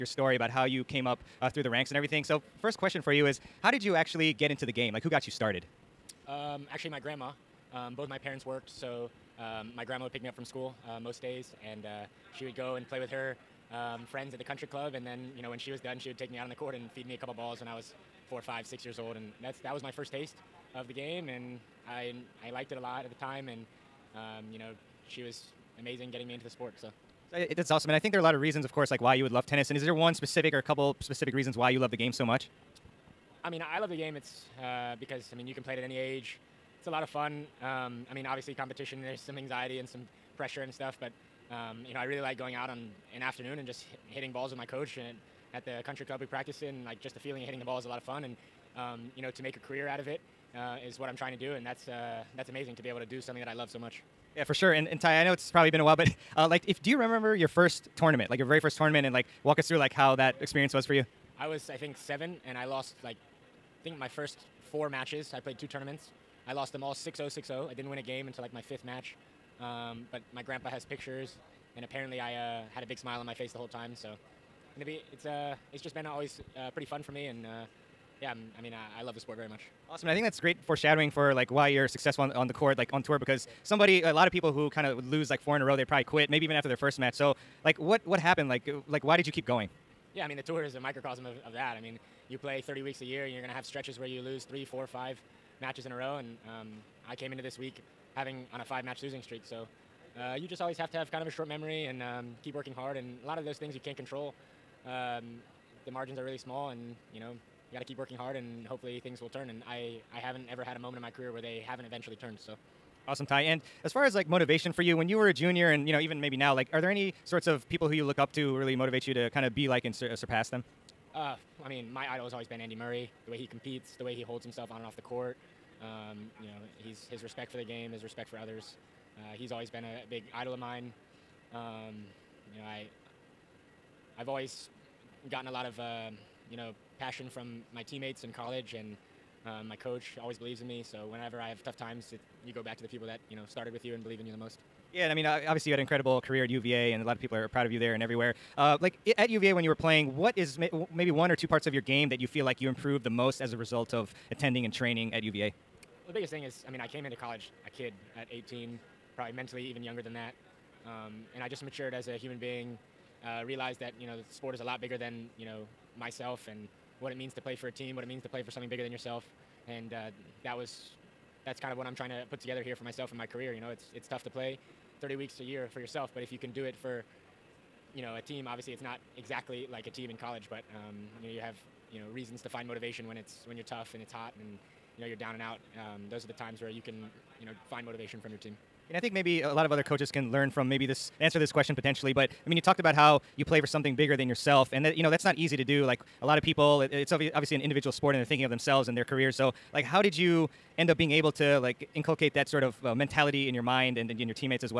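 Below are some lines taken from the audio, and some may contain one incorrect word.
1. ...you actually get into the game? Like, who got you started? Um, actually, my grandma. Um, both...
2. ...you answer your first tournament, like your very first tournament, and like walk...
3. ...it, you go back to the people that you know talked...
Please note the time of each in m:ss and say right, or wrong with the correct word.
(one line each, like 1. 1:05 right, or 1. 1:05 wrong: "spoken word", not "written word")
1. 0:03 right
2. 0:56 wrong: "remember", not "answer"
3. 2:22 wrong: "started", not "talked".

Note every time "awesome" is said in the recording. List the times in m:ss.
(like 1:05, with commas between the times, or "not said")
0:27, 1:19, 1:53.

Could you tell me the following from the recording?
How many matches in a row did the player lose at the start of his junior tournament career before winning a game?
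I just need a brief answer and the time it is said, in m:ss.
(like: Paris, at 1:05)
4, at 1:04.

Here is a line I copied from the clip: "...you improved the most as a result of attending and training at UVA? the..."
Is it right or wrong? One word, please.
right.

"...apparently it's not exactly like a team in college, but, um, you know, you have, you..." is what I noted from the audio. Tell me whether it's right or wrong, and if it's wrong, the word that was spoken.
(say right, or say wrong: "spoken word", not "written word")
wrong: "obviously", not "apparently".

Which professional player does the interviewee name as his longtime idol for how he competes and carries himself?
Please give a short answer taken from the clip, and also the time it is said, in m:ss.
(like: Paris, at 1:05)
Andy Murray, at 2:02.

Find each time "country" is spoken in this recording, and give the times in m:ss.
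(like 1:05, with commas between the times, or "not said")
0:14, 0:45.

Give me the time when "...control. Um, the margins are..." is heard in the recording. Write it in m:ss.
1:43.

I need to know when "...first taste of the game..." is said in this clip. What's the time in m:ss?
0:19.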